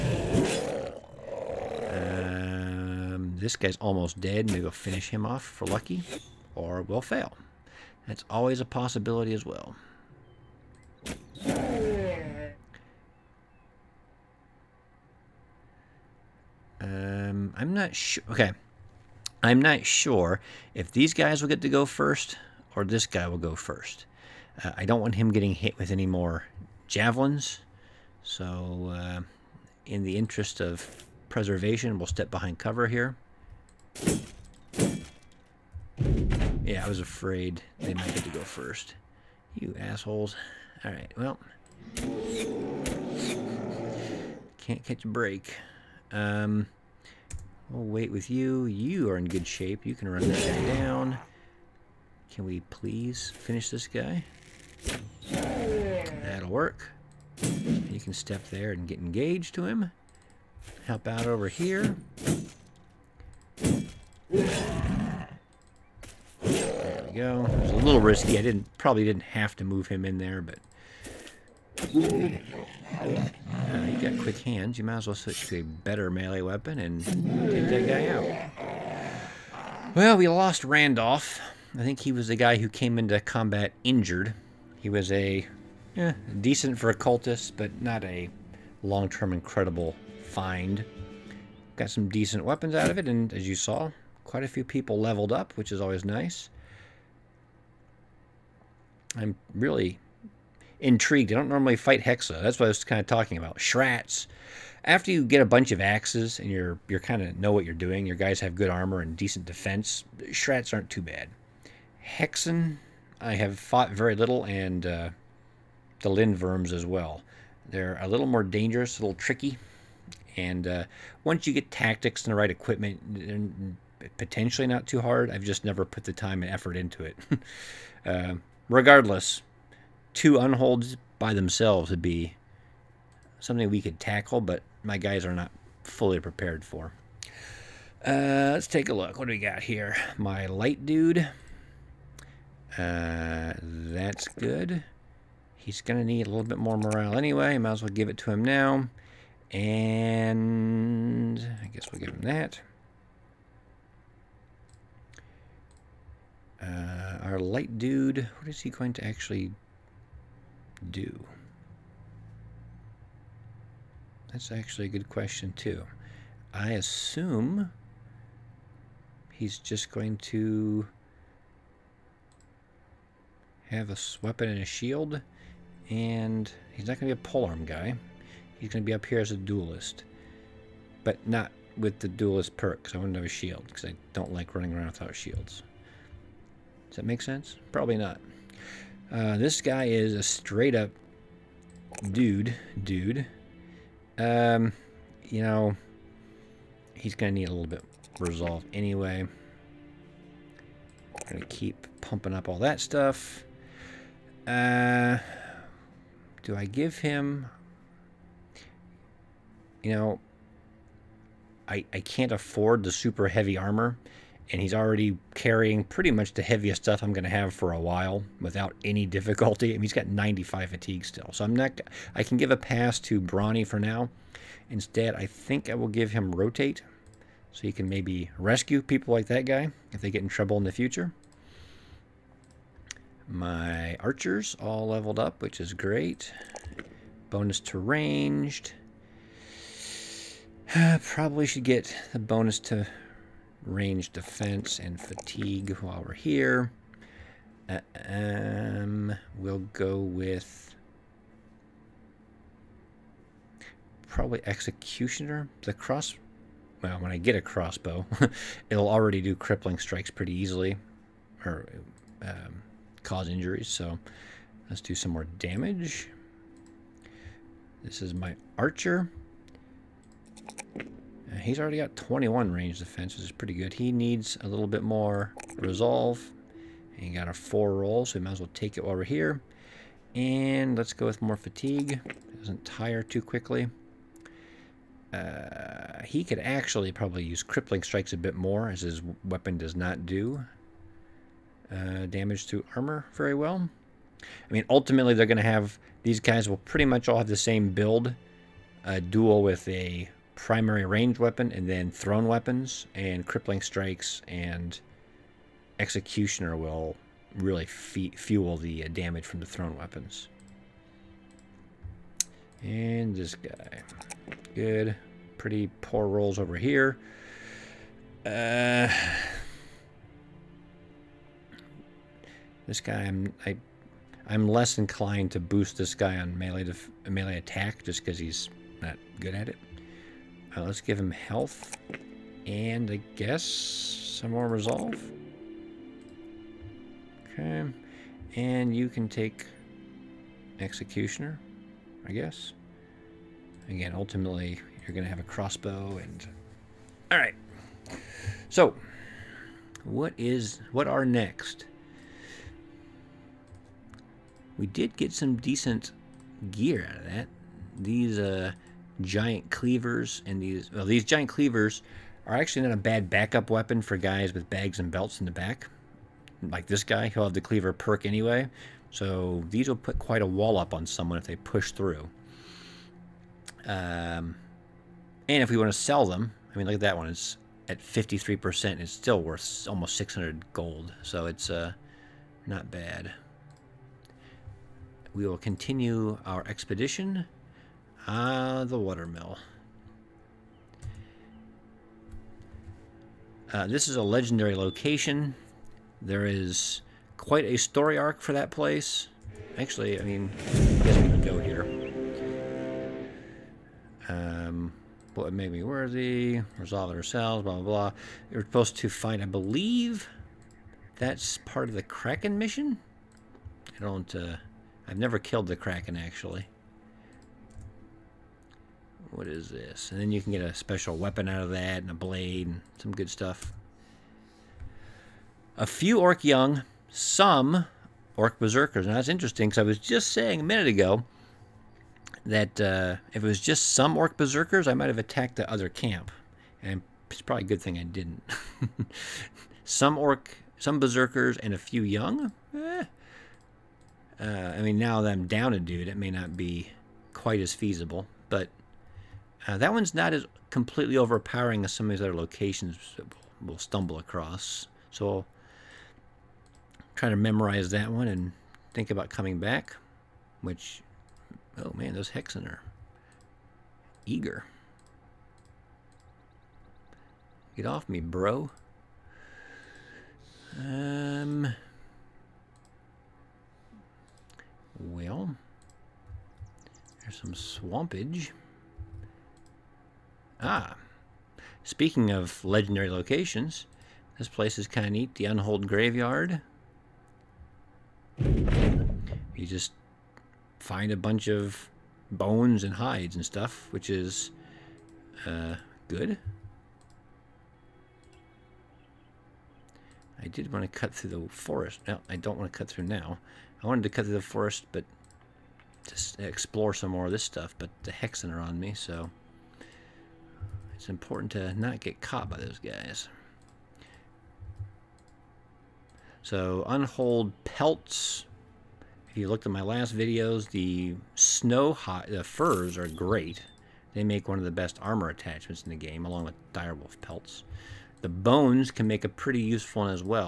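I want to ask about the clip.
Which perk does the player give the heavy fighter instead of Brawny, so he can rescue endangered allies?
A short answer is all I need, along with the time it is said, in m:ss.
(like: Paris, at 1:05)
Rotate, at 3:46.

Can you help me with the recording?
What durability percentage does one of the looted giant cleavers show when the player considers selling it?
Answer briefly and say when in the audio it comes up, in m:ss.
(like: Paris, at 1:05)
53%, at 6:17.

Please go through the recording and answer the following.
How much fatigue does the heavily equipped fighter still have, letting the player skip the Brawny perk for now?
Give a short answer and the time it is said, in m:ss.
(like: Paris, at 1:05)
95, at 3:40.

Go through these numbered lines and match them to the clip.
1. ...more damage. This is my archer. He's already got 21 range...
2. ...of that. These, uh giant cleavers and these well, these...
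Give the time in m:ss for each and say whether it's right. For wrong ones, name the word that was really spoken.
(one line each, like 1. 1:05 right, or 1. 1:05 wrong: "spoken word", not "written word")
1. 4:25 right
2. 5:56 right.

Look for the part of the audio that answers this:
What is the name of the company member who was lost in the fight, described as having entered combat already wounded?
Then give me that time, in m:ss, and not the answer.
1:20.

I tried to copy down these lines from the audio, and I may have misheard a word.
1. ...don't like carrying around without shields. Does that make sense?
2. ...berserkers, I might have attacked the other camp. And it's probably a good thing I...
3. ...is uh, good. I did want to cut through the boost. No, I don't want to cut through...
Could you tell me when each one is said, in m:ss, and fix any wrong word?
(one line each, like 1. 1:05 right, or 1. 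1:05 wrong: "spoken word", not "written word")
1. 3:04 wrong: "running", not "carrying"
2. 7:14 right
3. 8:13 wrong: "forest", not "boost".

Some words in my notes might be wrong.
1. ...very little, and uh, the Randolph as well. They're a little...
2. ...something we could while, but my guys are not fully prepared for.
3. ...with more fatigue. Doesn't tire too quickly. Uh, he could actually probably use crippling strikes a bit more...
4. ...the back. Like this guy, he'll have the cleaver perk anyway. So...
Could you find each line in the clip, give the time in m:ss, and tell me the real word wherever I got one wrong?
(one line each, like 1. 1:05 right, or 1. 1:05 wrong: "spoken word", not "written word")
1. 1:53 wrong: "Lindworms", not "Randolph"
2. 2:13 wrong: "tackle", not "while"
3. 4:41 right
4. 6:05 right.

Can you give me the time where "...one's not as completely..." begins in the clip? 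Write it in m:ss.
7:29.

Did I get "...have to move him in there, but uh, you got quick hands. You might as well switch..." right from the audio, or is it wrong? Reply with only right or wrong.
right.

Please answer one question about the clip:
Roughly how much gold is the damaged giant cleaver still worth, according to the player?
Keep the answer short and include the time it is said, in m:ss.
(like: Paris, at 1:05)
almost 600 gold, at 6:19.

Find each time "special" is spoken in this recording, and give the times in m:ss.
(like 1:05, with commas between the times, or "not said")
7:00.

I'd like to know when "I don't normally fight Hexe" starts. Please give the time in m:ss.
1:41.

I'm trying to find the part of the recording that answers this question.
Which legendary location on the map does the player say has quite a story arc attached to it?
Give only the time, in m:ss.
6:28.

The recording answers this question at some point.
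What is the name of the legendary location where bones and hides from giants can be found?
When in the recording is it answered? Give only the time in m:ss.
8:05.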